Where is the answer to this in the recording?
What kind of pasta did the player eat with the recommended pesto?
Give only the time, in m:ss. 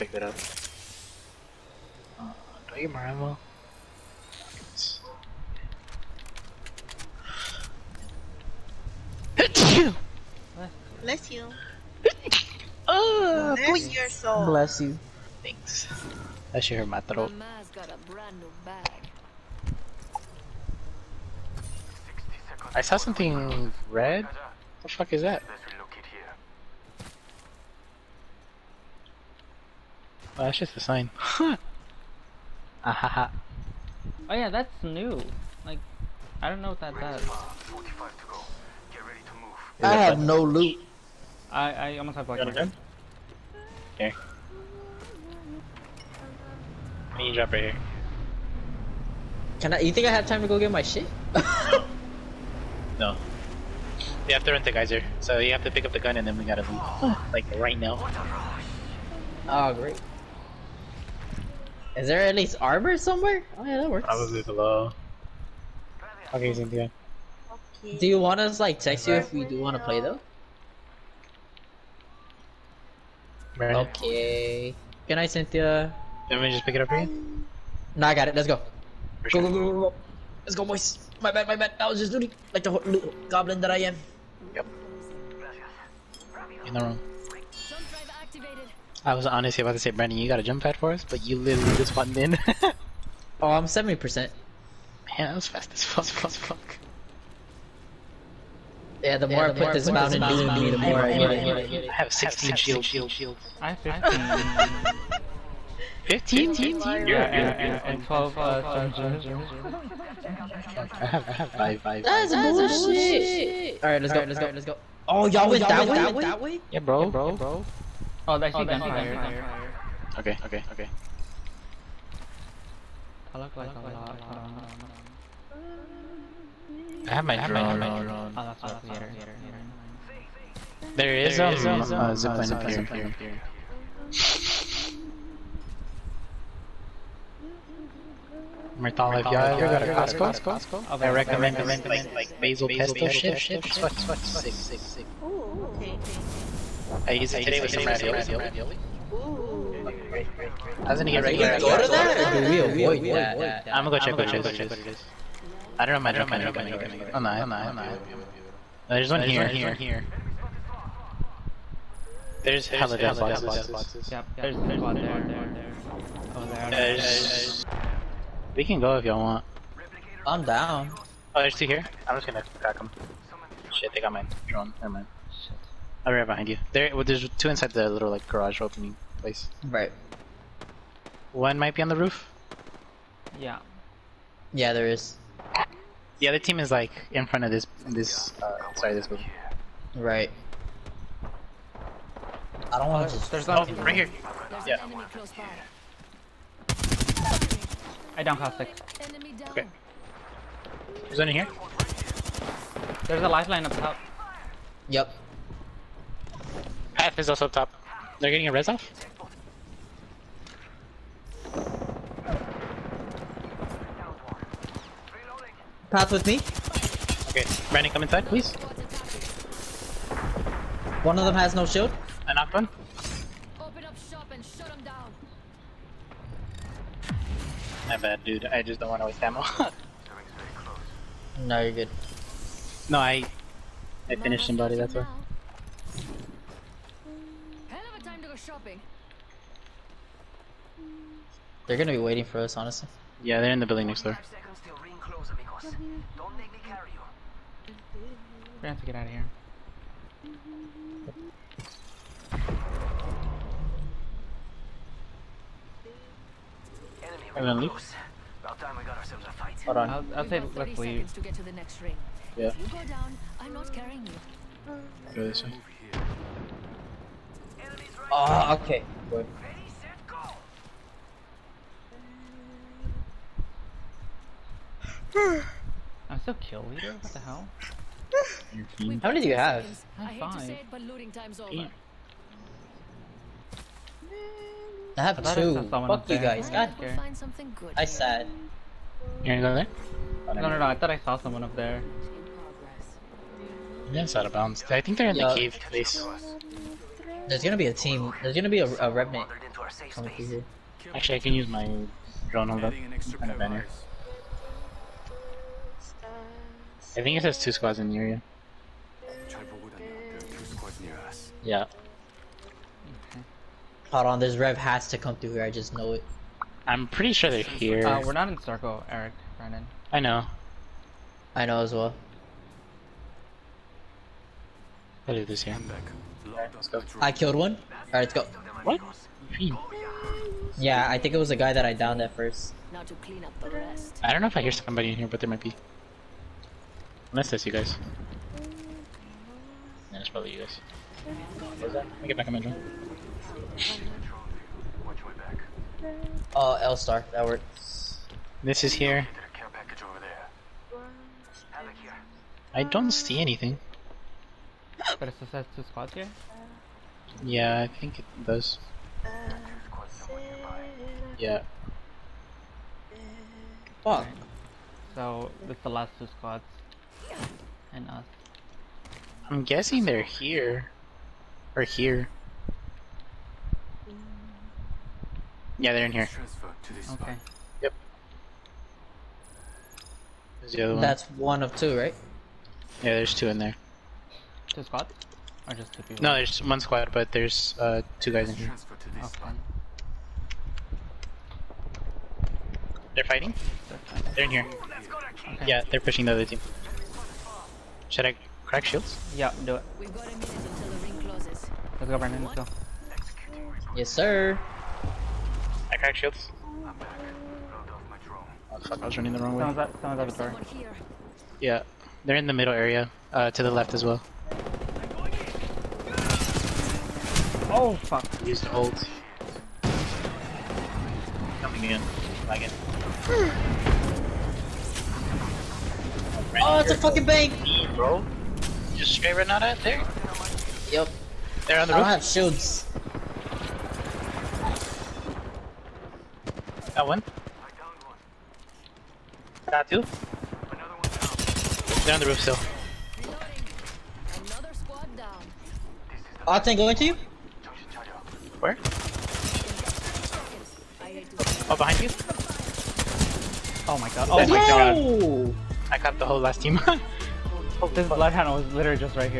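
2:27.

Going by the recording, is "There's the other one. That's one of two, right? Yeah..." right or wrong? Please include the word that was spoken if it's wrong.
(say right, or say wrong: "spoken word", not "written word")
right.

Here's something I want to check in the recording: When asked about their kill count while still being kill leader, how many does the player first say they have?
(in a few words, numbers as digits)
5.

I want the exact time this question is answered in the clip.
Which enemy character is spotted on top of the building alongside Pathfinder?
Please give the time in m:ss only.
3:23.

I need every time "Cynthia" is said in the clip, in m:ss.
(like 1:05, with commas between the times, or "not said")
1:06, 1:15.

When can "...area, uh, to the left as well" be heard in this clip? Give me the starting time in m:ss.
6:52.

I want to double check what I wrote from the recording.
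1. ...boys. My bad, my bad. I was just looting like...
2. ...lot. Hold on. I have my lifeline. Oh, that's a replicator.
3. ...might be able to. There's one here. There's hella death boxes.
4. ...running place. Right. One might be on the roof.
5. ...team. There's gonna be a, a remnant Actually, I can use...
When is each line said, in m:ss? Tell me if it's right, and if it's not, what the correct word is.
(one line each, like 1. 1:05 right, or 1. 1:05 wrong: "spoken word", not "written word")
1. 1:20 right
2. 2:03 wrong: "drone", not "lifeline"
3. 2:37 right
4. 2:58 wrong: "opening", not "running"
5. 4:57 right.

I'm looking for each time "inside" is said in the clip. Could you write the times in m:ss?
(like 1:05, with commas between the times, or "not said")
2:57, 3:38.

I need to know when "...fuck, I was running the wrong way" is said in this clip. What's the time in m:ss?
6:48.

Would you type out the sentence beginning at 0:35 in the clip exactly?
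Like, I don't know what that does.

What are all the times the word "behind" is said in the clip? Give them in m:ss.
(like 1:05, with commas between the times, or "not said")
2:56, 7:31.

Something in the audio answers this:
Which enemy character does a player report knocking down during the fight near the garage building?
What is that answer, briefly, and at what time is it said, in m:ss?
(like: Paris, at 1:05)
Caustic, at 3:18.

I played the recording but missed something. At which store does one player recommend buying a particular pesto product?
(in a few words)
Costco.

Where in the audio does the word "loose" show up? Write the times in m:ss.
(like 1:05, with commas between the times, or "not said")
4:17.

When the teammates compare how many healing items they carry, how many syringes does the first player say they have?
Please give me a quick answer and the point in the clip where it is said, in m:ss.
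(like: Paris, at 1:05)
12, at 1:48.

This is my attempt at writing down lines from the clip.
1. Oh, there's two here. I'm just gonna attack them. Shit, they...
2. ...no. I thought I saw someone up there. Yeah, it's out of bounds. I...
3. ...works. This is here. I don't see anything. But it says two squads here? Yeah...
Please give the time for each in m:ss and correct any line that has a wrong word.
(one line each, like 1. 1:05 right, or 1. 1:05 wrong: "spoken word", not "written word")
1. 2:51 right
2. 4:50 right
3. 5:47 right.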